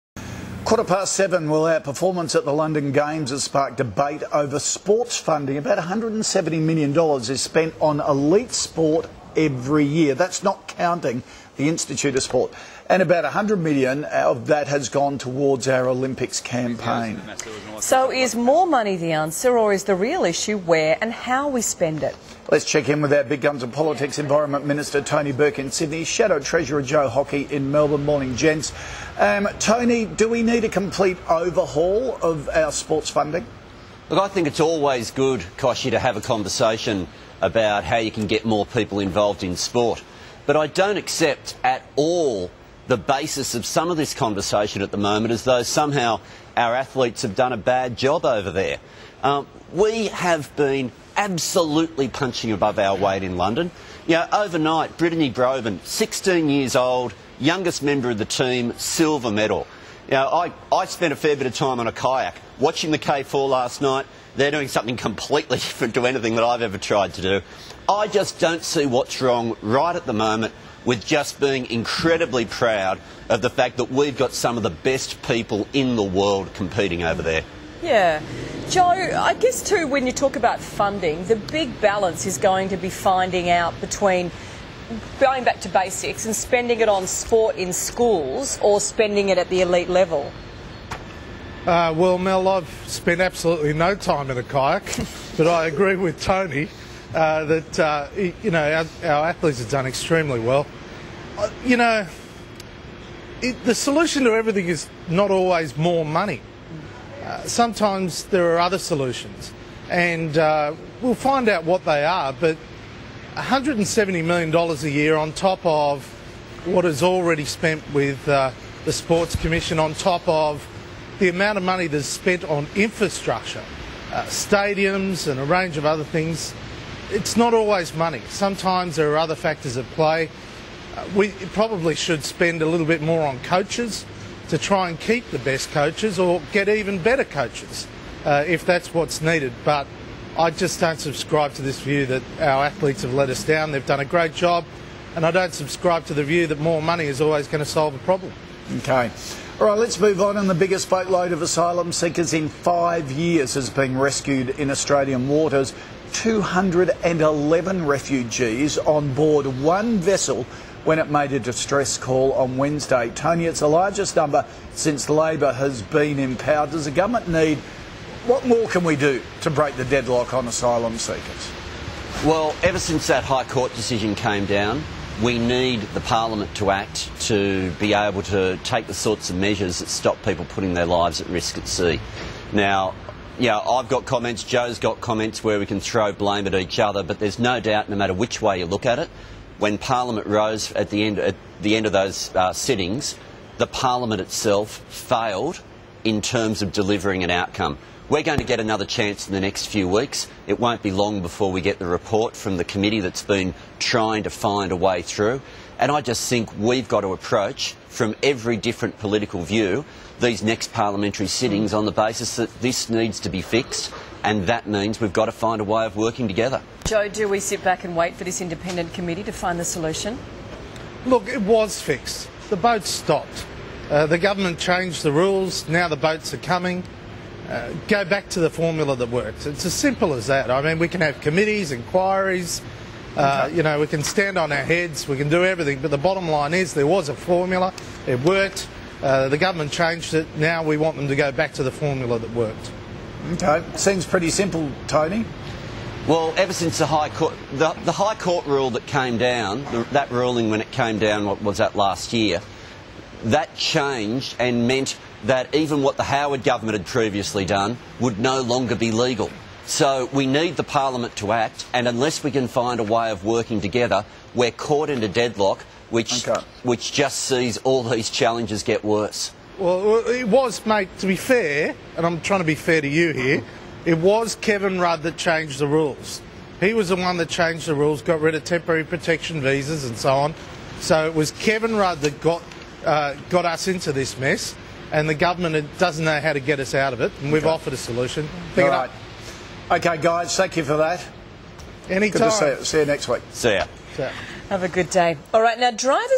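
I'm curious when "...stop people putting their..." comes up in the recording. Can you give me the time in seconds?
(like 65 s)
179 s.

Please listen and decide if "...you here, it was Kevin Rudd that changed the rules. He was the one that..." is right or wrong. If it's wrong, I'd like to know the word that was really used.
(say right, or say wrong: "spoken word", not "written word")
right.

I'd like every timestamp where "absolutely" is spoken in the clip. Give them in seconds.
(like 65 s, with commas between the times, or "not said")
51 s, 93 s.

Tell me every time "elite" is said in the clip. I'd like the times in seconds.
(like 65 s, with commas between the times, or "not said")
7 s, 89 s.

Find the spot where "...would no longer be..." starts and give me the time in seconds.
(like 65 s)
257 s.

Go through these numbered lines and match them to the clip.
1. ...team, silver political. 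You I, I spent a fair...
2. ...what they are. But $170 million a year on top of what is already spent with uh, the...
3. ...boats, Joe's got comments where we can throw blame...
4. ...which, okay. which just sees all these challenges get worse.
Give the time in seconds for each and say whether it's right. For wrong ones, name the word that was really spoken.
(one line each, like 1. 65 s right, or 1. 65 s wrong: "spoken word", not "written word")
1. 58 s wrong: "medal", not "political"
2. 111 s right
3. 184 s wrong: "comments", not "boats"
4. 265 s right.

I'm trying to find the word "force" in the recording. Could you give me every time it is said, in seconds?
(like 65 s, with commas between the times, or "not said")
not said.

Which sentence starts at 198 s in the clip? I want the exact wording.
We're going to get another chance in the next few weeks.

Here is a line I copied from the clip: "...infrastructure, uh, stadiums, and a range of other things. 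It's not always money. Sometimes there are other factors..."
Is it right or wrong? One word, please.
right.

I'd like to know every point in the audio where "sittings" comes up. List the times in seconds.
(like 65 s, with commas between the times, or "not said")
192 s, 211 s.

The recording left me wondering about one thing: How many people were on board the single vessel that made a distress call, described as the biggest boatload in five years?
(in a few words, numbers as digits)
211.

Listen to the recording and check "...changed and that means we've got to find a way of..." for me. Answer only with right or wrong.
wrong.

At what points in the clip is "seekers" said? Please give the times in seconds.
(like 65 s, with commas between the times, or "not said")
151 s, 170 s.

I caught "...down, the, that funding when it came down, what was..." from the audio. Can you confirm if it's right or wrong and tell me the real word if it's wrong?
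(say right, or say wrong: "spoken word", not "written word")
wrong: "ruling", not "funding".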